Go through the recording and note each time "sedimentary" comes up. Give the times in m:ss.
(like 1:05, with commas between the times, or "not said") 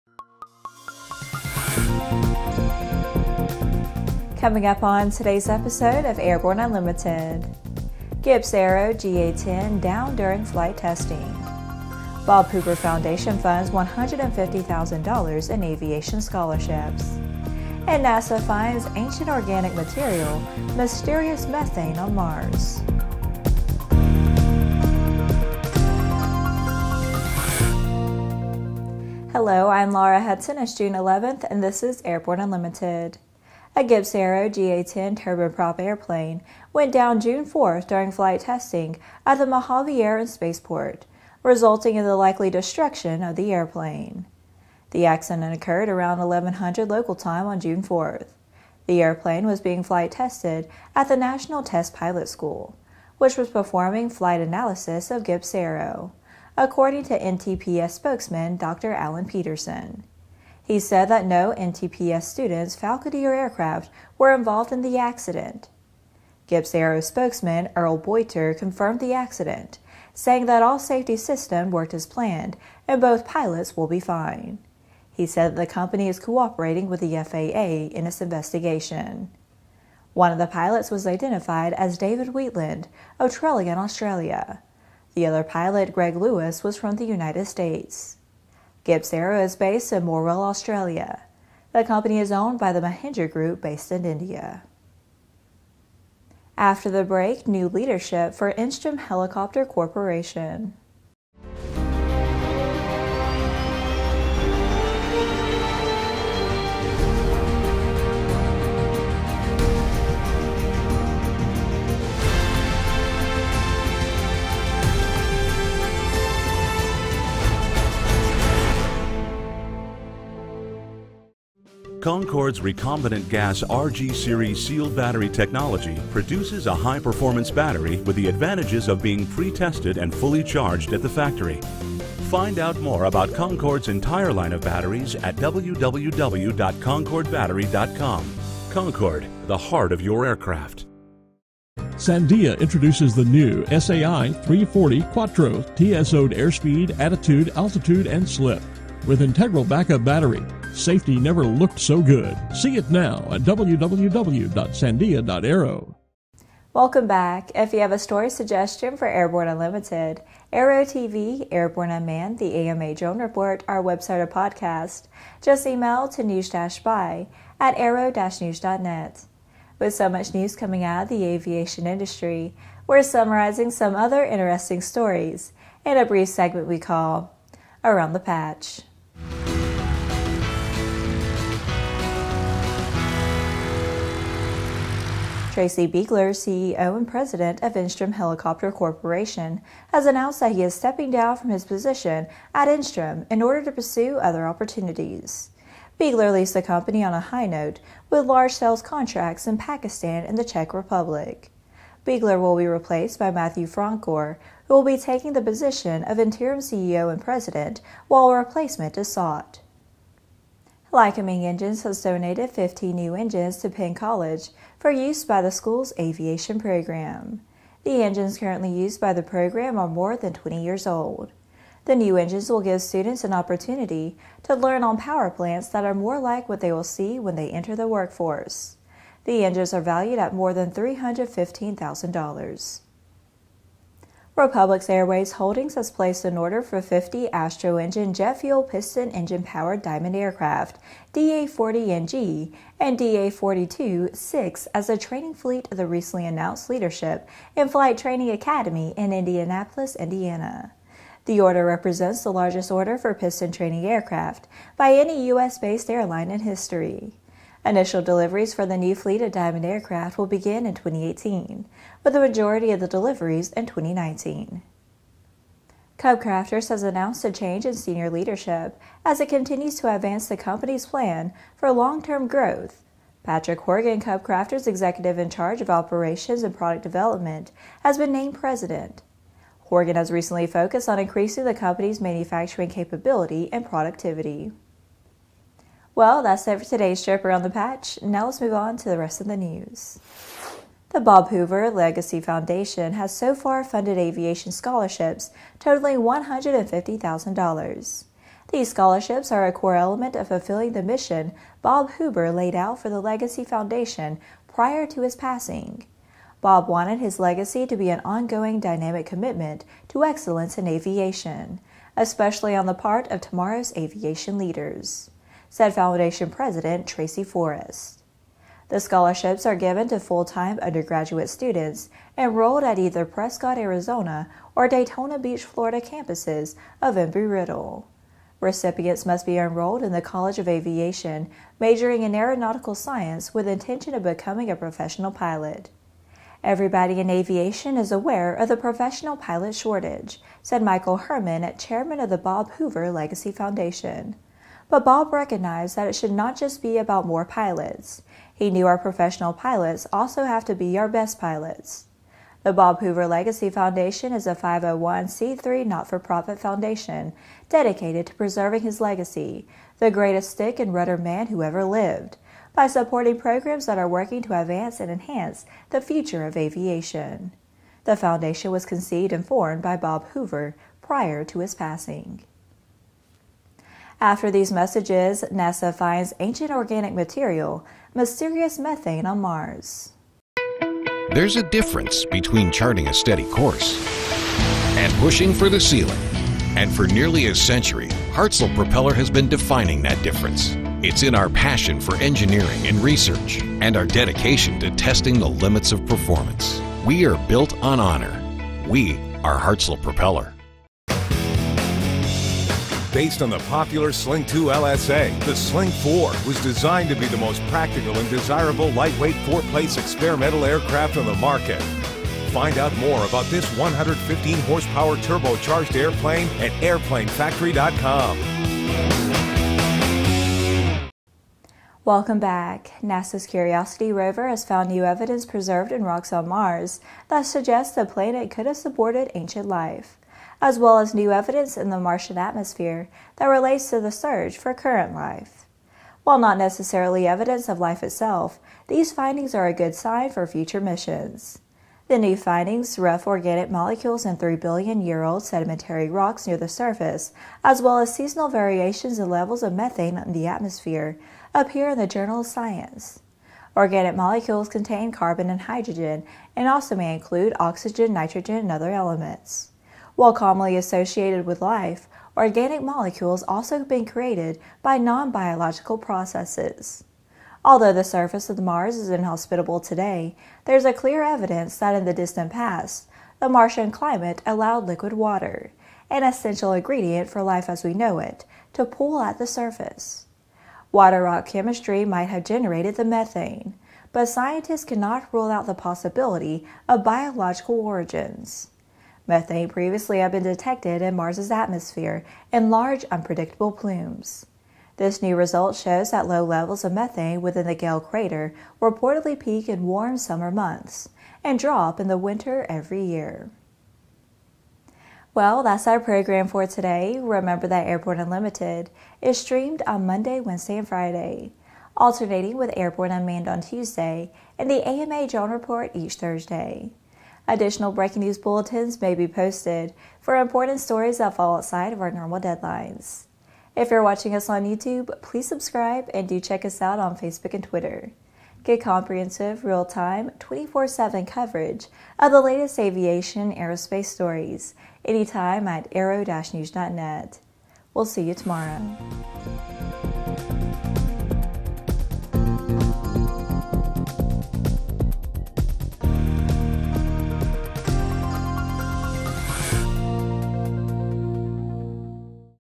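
7:25.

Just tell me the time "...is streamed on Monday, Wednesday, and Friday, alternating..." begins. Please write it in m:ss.
8:29.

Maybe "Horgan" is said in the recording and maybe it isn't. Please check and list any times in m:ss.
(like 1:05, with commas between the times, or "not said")
4:33, 4:39.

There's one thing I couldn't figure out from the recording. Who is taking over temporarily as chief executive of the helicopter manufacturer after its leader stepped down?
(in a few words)
Matthew Francor.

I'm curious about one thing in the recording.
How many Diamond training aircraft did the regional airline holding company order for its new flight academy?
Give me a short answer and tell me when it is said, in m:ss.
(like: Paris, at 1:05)
50, at 3:56.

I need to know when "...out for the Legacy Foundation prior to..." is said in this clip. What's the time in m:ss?
5:02.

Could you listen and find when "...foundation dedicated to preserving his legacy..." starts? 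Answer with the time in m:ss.
5:56.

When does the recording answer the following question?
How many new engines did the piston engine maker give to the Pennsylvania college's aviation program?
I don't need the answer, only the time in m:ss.
3:32.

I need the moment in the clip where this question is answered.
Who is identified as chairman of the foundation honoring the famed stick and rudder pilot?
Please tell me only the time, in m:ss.
5:40.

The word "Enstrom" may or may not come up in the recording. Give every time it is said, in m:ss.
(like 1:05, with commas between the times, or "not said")
1:38, 3:07, 3:12.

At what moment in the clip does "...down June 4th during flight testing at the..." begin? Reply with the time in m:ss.
0:36.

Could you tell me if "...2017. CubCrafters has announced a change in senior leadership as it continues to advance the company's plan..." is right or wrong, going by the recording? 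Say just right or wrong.
wrong.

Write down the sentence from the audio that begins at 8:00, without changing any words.
Water rock chemistry might have generated the methane, but scientists cannot rule out the possibility of biological origins.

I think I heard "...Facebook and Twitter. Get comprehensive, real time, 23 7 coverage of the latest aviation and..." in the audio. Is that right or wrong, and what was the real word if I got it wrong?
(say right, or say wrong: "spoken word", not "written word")
wrong: "24", not "23".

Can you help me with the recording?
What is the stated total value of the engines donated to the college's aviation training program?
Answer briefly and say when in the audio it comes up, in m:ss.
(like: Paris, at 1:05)
$315,000, at 3:50.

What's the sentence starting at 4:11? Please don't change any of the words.
The order represents the largest order for piston training aircraft by any U.S.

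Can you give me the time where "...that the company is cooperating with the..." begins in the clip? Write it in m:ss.
1:15.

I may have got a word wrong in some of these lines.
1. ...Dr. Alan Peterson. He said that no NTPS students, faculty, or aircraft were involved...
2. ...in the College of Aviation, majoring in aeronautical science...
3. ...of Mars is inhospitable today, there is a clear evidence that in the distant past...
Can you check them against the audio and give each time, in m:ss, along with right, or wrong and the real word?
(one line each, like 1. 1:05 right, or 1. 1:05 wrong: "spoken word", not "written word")
1. 0:58 right
2. 5:29 right
3. 7:48 right.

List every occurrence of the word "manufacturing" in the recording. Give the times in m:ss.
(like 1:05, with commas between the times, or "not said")
4:42.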